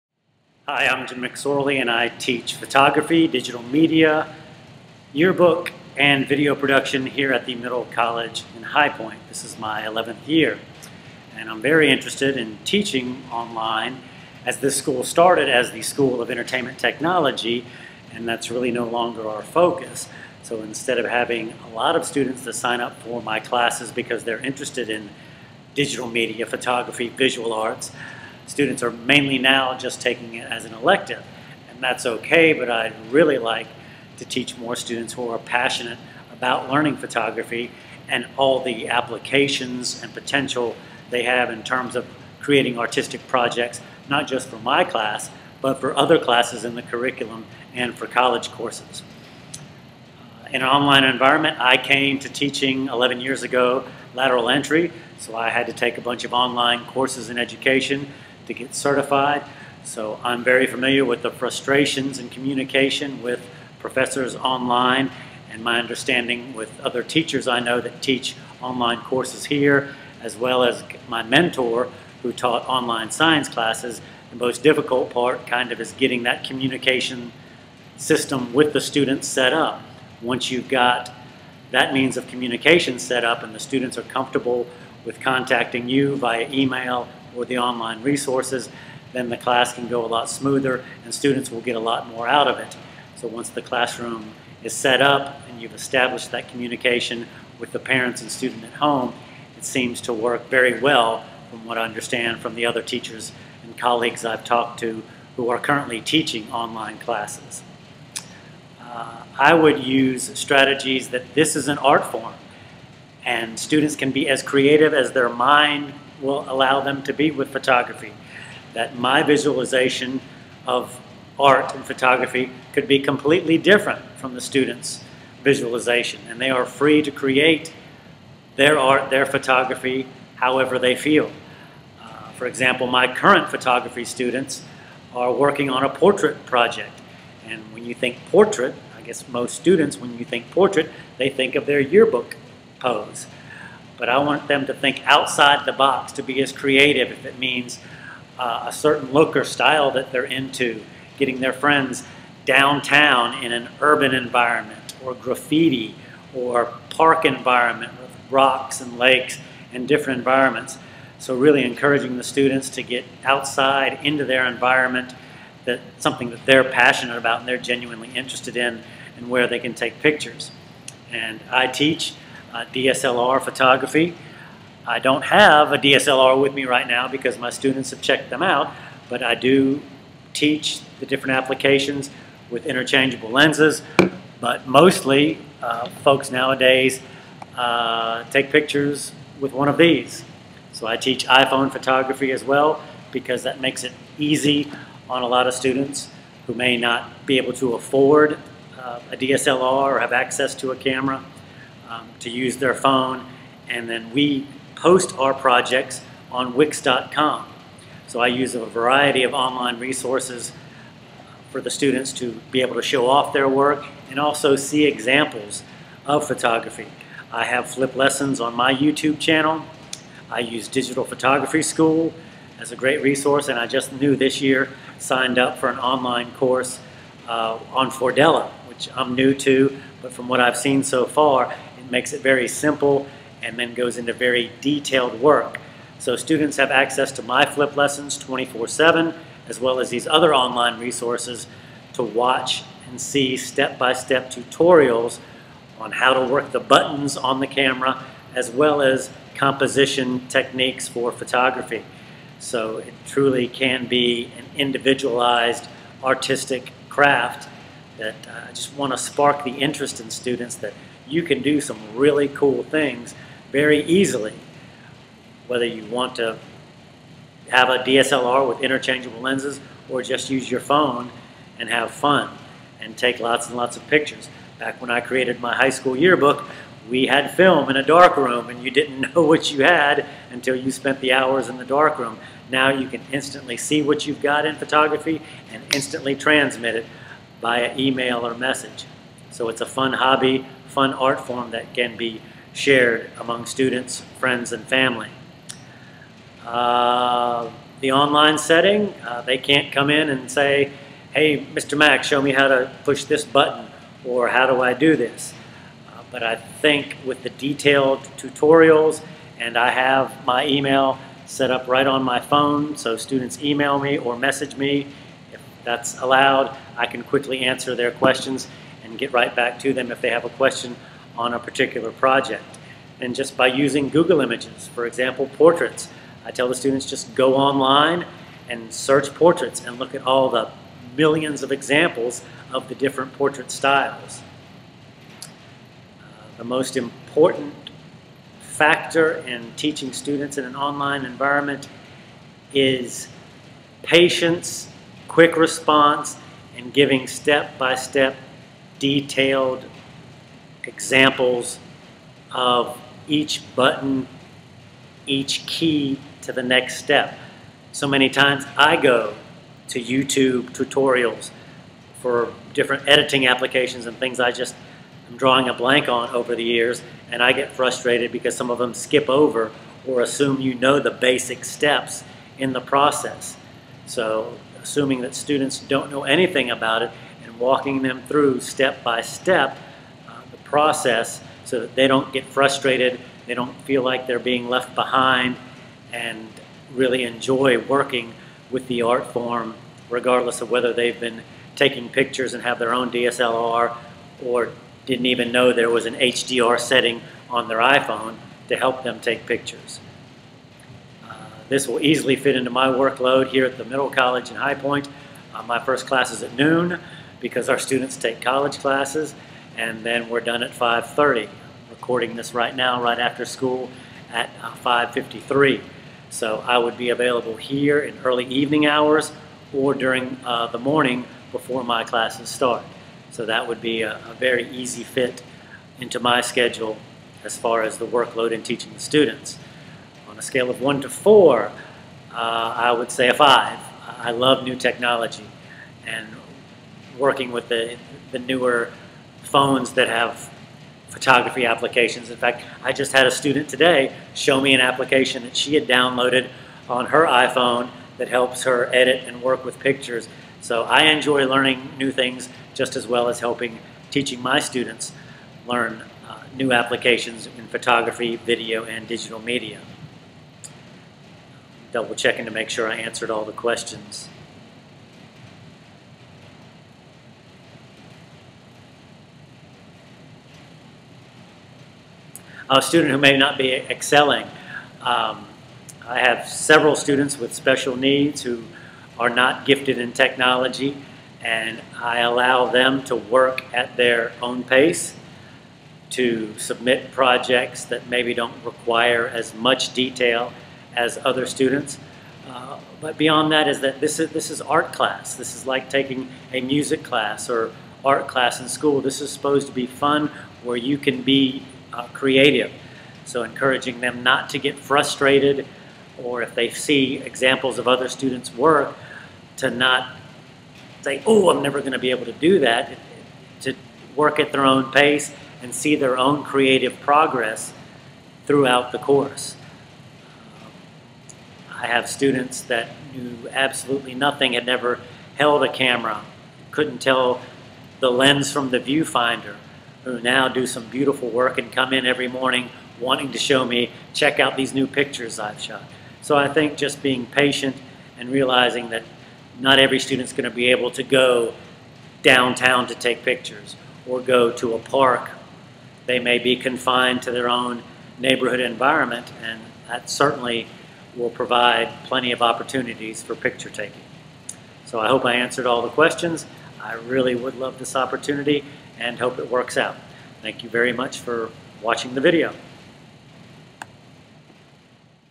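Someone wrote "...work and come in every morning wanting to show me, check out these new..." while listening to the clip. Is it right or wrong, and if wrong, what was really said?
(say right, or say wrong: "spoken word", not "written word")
right.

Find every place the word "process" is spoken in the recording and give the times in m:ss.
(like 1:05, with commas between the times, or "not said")
6:12, 6:20.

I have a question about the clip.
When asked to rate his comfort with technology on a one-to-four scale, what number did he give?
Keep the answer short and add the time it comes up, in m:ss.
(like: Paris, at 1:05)
5, at 7:13.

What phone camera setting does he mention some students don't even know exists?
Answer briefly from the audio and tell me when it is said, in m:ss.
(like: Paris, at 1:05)
HDR, at 6:35.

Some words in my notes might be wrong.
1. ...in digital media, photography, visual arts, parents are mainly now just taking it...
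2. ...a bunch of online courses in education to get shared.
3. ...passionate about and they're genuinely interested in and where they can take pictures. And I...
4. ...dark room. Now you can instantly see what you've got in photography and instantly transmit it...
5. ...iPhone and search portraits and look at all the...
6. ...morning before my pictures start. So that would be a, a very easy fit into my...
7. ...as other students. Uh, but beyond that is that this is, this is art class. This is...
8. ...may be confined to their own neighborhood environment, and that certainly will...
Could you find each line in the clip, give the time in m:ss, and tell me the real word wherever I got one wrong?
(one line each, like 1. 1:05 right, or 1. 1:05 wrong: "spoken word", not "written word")
1. 0:24 wrong: "students", not "parents"
2. 0:55 wrong: "certified", not "shared"
3. 2:46 right
4. 4:41 right
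5. 5:27 wrong: "online", not "iPhone"
6. 7:00 wrong: "classes", not "pictures"
7. 8:10 right
8. 9:05 right.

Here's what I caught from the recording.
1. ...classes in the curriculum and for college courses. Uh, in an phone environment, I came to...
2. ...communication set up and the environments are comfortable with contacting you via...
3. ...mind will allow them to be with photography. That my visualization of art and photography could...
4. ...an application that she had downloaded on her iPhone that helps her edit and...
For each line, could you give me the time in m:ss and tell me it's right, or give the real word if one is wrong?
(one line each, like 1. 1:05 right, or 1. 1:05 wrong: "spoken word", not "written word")
1. 0:46 wrong: "online", not "phone"
2. 1:22 wrong: "students", not "environments"
3. 1:55 right
4. 7:24 right.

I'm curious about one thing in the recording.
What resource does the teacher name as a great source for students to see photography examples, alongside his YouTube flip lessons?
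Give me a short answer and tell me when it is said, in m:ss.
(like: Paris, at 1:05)
Digital Photography School, at 3:40.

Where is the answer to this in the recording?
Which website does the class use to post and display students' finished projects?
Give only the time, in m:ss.
3:26.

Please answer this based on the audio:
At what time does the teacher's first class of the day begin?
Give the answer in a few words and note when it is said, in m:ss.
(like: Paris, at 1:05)
noon, at 6:46.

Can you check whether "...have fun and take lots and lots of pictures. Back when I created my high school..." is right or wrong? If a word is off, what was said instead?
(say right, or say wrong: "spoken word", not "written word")
right.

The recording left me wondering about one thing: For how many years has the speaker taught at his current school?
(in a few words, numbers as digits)
11th.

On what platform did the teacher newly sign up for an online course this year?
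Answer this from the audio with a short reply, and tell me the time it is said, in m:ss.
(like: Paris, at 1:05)
Fordella, at 3:47.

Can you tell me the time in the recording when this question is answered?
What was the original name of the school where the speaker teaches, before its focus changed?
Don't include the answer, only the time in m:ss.
0:15.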